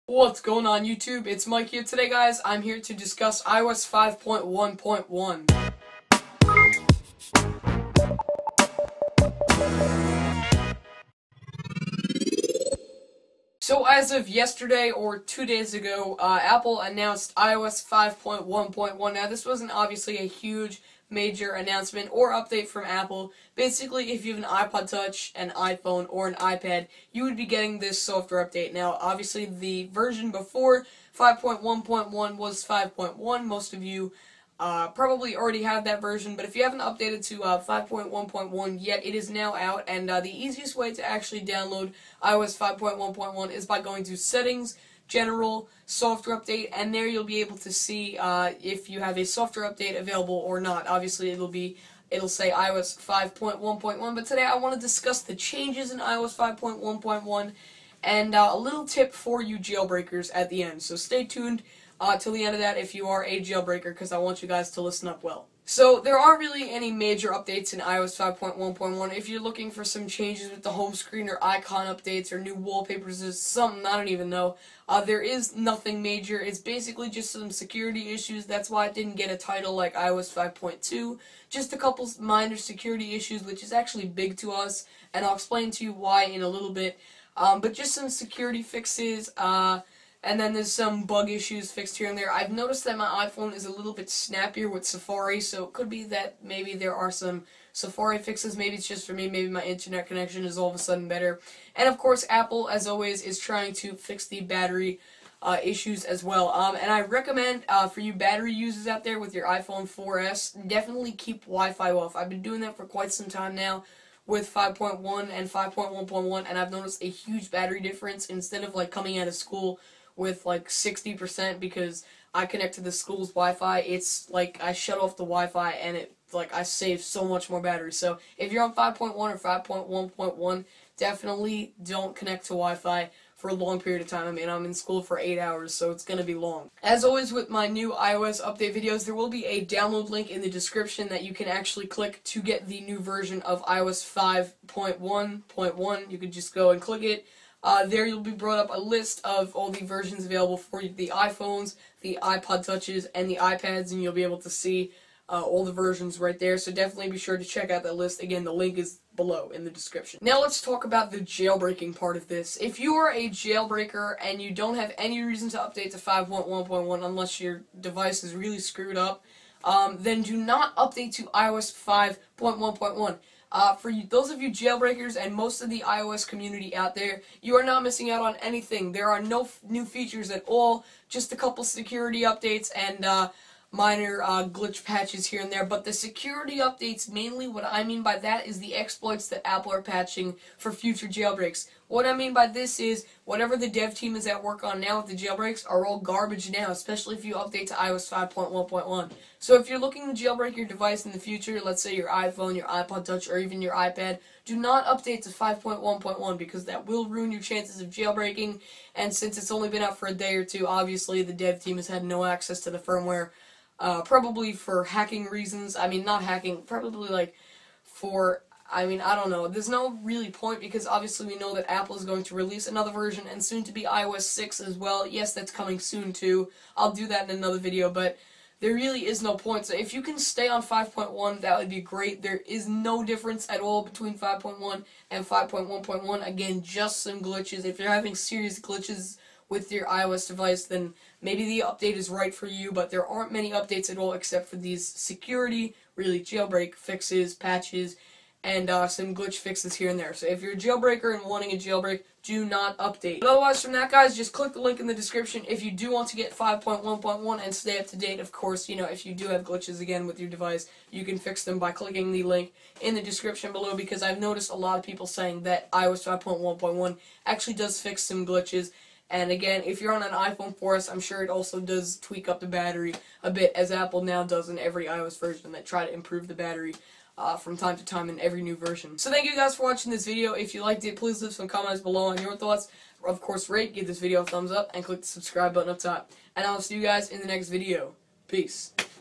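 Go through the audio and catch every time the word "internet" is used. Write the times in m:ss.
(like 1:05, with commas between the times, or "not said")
1:39.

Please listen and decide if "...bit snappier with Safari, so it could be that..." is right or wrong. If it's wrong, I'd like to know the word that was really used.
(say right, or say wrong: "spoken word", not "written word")
right.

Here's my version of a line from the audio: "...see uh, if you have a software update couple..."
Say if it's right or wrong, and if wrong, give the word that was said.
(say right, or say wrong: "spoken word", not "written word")
wrong: "available", not "couple".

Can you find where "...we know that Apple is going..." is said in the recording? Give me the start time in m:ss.
3:41.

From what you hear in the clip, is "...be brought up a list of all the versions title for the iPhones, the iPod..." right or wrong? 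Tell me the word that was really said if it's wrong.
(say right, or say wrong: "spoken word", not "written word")
wrong: "available", not "title".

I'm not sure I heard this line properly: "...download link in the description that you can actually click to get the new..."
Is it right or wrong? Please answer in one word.
right.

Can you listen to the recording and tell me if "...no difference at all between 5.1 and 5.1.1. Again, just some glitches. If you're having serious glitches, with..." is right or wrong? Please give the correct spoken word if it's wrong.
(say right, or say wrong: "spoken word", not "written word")
right.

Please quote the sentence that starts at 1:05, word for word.
So there aren't really any major updates in iOS 5.1.1.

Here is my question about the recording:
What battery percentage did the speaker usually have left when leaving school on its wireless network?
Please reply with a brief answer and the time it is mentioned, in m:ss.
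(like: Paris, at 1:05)
60%, at 2:00.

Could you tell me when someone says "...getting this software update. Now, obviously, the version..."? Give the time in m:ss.
0:27.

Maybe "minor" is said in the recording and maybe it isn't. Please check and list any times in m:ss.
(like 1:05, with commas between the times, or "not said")
1:22, 3:03.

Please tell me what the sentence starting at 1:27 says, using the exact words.
Um, but just some security fixes.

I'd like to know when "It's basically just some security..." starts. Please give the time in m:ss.
1:16.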